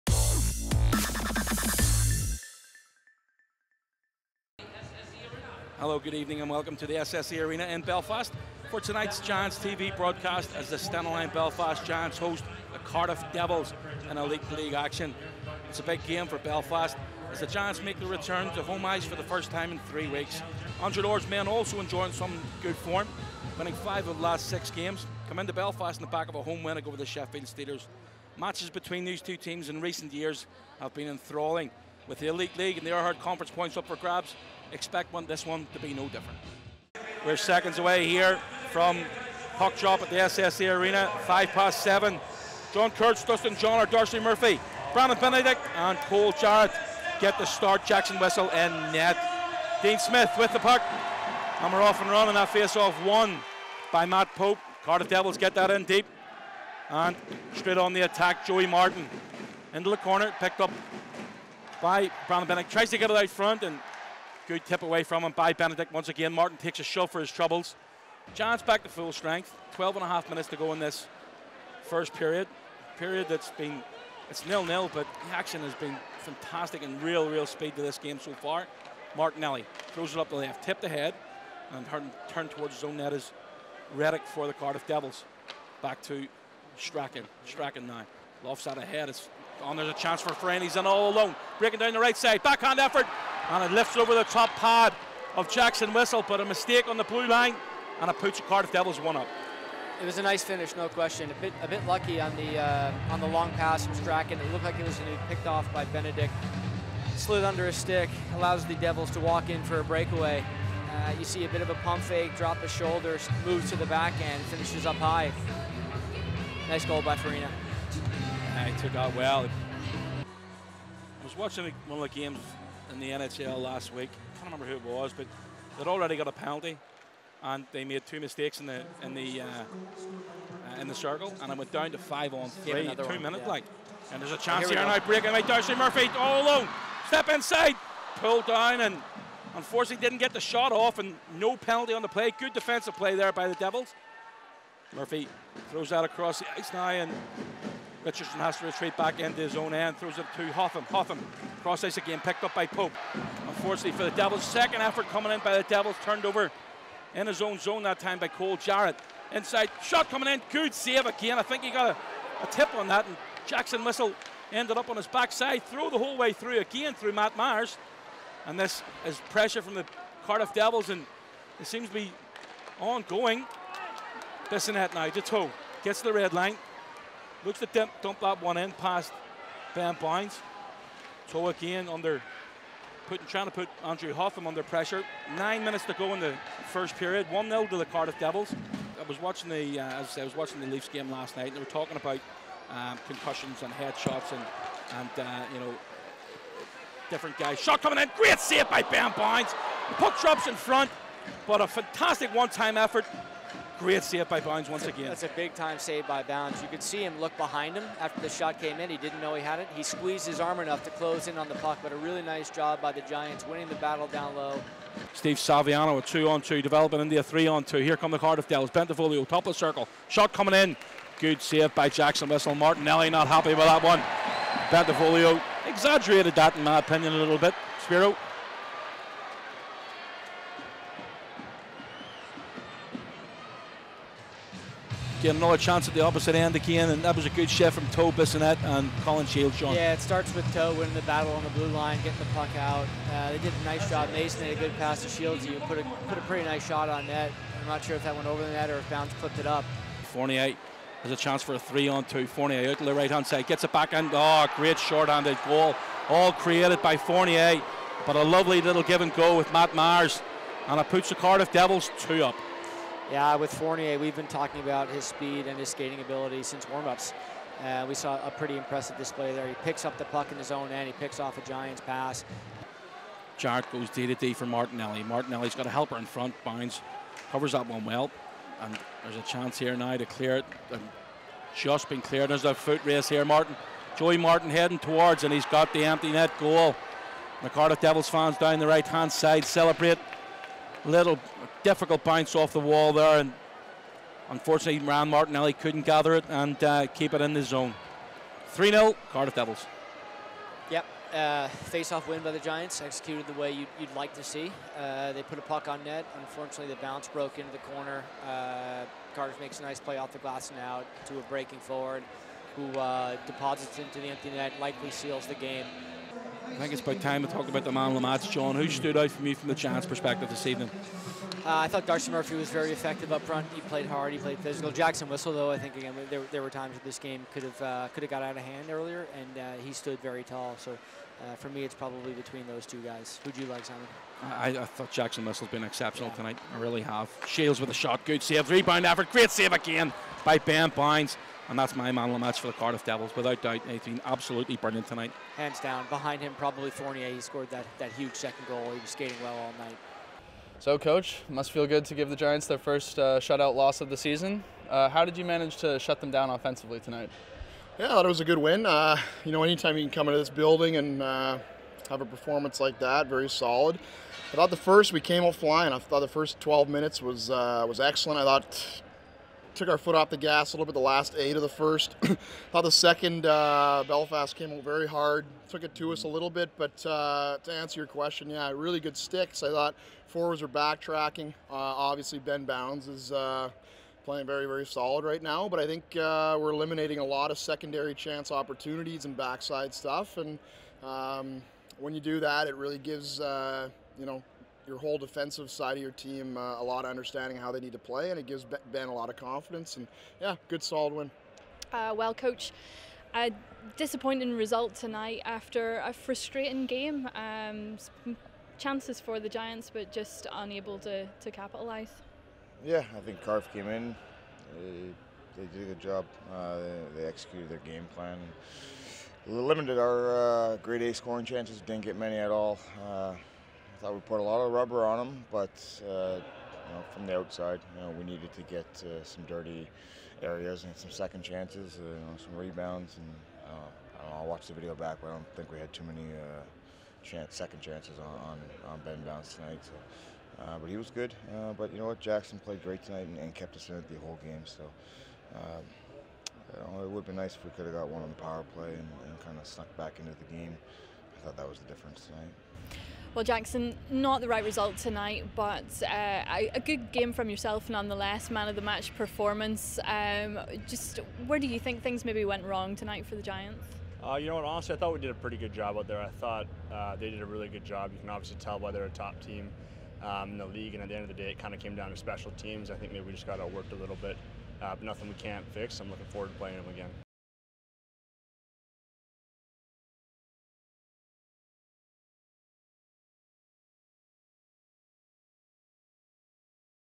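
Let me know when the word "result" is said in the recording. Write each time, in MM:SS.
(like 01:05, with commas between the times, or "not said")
06:44, 07:34.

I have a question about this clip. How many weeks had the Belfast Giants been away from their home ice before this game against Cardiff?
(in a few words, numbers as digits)
3.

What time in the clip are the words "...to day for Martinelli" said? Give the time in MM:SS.
04:34.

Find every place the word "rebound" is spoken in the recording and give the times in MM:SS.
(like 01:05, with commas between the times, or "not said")
05:38, 07:12.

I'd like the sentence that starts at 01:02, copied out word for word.
Tries to get it out front, and Good tip away from him by Benedict once again.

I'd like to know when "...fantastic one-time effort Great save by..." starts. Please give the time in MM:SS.
03:21.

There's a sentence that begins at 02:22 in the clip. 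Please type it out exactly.
Good defensive play there by the Devils.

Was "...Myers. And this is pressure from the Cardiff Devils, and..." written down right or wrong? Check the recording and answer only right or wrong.
right.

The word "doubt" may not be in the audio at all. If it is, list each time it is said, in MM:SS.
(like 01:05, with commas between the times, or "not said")
05:43.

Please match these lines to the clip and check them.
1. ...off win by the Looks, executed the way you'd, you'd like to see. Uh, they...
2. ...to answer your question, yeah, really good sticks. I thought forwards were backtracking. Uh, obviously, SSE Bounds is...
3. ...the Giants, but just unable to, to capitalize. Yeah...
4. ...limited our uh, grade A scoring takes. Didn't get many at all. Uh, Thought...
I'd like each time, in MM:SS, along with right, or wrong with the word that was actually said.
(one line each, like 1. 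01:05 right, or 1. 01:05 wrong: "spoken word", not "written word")
1. 05:01 wrong: "Giants", not "Looks"
2. 06:17 wrong: "Ben", not "SSE"
3. 06:49 right
4. 06:59 wrong: "chances", not "takes".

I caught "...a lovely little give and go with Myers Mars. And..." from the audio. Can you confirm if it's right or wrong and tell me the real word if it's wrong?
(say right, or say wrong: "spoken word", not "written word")
wrong: "Matt", not "Myers".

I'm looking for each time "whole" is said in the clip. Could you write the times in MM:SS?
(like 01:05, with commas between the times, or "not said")
02:45, 06:34, 07:24.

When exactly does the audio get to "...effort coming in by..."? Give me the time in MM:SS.
02:34.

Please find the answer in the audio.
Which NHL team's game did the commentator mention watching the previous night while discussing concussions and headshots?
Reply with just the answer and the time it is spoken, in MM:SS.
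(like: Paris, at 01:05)
Leafs, at 03:10.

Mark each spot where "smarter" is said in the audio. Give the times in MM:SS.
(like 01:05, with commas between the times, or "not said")
not said.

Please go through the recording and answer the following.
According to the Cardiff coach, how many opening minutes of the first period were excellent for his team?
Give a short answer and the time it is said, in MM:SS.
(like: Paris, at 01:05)
12, at 06:06.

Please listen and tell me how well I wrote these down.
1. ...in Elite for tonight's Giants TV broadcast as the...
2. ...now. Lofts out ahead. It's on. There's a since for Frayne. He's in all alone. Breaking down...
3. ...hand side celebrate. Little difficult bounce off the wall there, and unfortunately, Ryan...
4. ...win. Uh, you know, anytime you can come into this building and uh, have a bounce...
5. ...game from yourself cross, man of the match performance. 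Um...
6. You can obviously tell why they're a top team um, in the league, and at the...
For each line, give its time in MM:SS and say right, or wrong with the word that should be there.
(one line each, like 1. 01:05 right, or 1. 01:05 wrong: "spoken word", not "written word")
1. 00:07 wrong: "Belfast", not "Elite"
2. 01:27 wrong: "chance", not "since"
3. 04:48 right
4. 05:58 wrong: "performance", not "bounce"
5. 07:36 wrong: "nonetheless", not "cross"
6. 07:47 right.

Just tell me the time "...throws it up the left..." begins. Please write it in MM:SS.
01:19.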